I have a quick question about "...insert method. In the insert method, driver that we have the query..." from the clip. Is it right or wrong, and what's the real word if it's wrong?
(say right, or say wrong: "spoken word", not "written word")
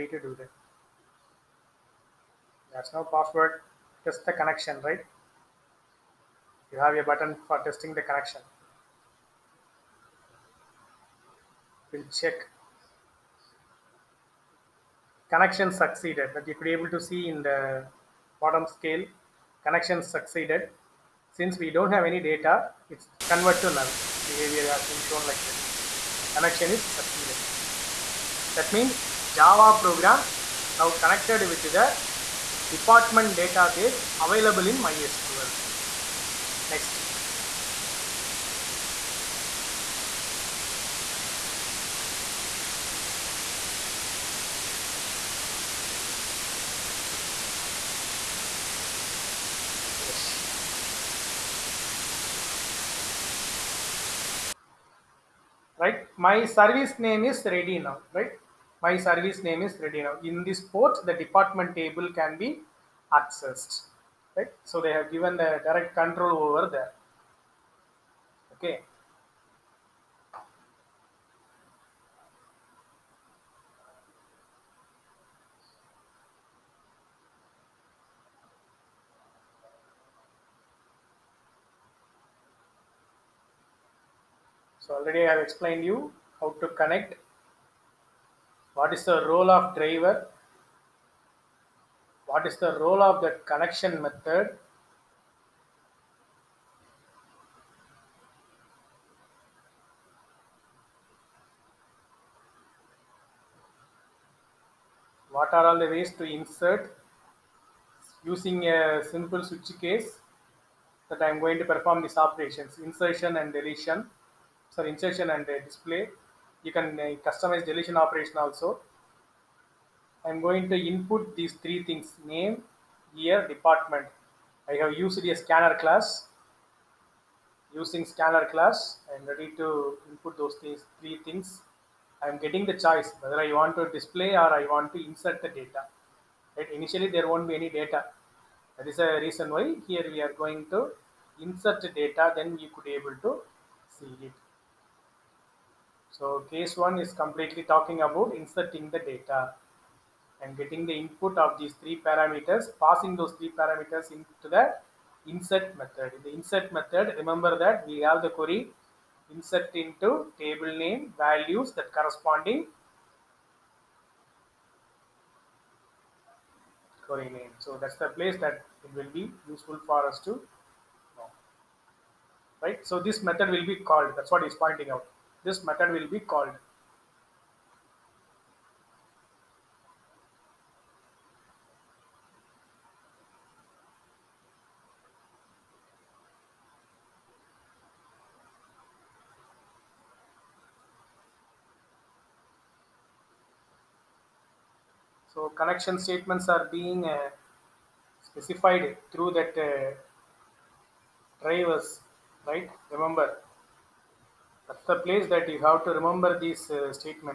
wrong: "remember", not "driver".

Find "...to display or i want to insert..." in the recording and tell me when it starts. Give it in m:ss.
2:13.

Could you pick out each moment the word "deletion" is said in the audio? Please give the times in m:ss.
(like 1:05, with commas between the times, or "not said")
1:53, 1:57.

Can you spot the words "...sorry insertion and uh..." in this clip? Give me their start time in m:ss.
1:54.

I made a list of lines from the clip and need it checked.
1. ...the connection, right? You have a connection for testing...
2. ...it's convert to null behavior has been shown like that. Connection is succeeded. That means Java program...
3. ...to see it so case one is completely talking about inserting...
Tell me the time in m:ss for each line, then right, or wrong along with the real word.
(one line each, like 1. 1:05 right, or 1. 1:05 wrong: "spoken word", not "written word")
1. 0:04 wrong: "button", not "connection"
2. 0:22 right
3. 2:23 right.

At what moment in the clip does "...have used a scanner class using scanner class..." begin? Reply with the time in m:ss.
2:04.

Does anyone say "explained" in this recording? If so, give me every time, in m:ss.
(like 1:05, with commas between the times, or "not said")
1:25.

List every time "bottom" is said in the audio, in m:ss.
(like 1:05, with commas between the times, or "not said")
0:18.